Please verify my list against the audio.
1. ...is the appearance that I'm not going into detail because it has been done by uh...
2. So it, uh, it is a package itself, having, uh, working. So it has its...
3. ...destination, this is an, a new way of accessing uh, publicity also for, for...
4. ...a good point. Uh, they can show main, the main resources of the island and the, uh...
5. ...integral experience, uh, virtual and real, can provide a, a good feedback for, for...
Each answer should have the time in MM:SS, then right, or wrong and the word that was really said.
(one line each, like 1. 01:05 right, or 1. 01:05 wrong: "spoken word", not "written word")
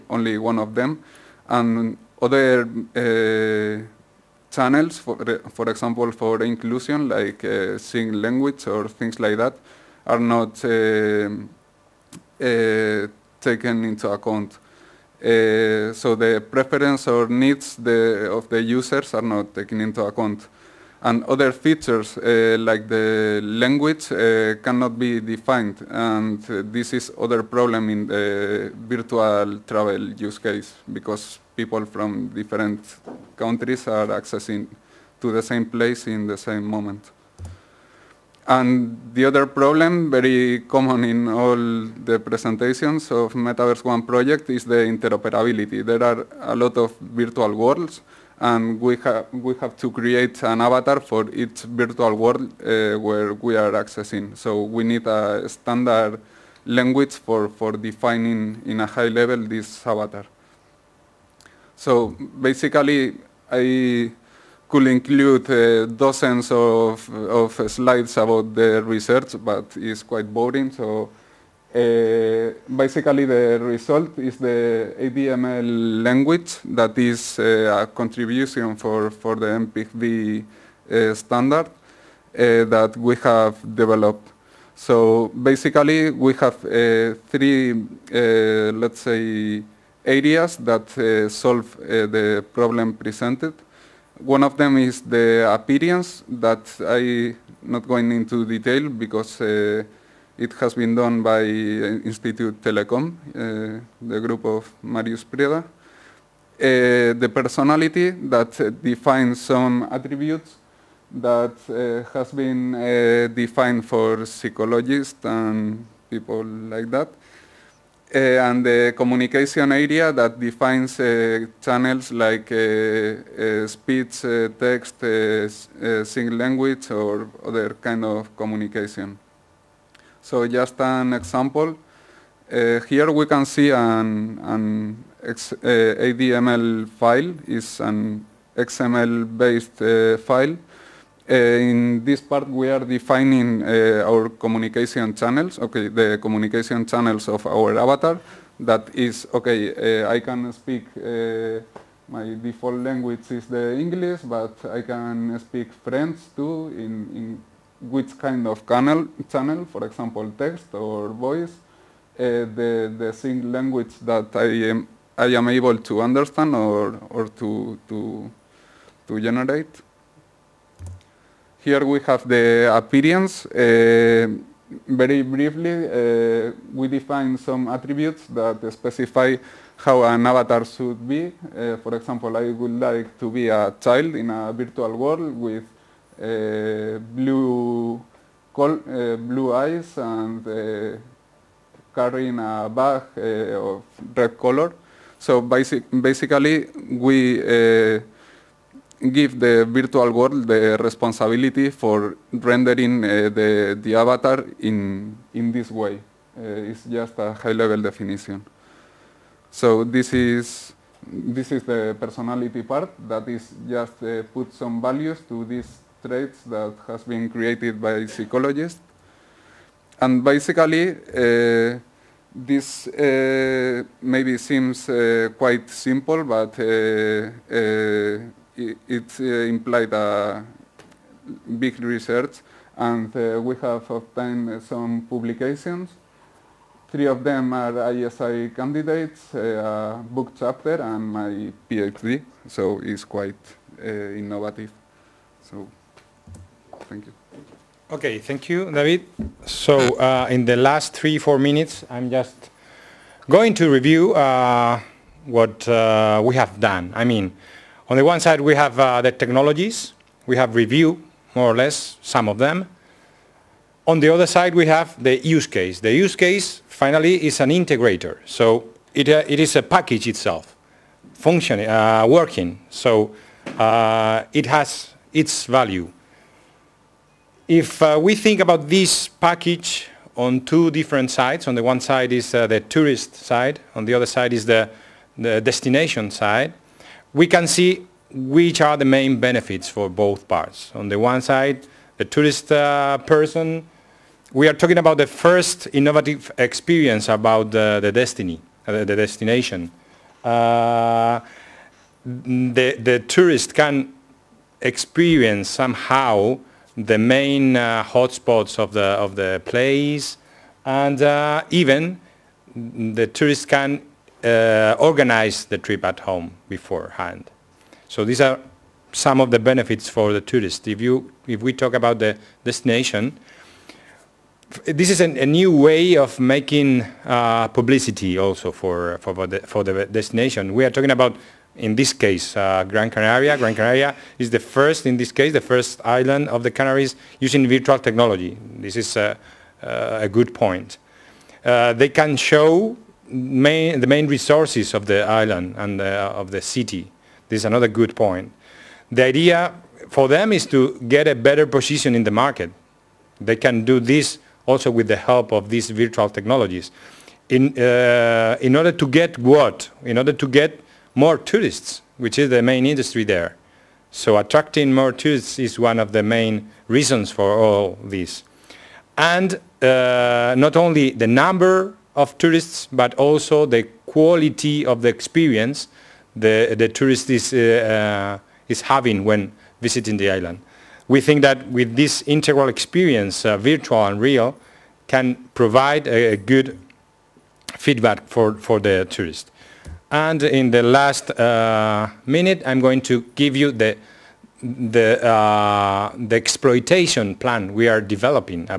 1. 01:34 right
2. 04:28 wrong: "functioning", not "having"
3. 05:22 wrong: "making", not "accessing"
4. 05:40 right
5. 06:22 right.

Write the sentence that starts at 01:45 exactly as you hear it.
Uh, the personality that defines some attributes that has been defined for psychologists and people like that.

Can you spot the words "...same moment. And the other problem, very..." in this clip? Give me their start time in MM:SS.
00:36.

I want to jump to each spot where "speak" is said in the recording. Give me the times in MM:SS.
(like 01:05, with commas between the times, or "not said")
02:30, 02:35.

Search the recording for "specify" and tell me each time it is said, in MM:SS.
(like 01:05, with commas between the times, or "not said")
02:58.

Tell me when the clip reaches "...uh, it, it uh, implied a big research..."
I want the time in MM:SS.
03:46.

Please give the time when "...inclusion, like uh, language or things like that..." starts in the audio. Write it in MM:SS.
00:06.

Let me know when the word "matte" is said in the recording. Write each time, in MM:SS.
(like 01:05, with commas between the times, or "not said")
not said.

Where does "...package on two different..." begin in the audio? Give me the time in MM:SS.
04:39.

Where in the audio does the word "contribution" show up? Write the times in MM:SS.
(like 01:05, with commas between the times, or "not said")
01:17.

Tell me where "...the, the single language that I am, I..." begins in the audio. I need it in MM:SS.
02:42.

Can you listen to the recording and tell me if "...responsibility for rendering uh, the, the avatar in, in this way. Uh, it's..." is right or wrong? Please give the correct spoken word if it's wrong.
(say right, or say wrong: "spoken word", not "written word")
right.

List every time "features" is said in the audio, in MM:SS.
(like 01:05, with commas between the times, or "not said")
00:21.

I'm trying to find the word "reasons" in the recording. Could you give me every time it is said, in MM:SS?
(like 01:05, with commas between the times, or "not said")
06:06.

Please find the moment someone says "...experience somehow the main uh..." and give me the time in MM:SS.
05:04.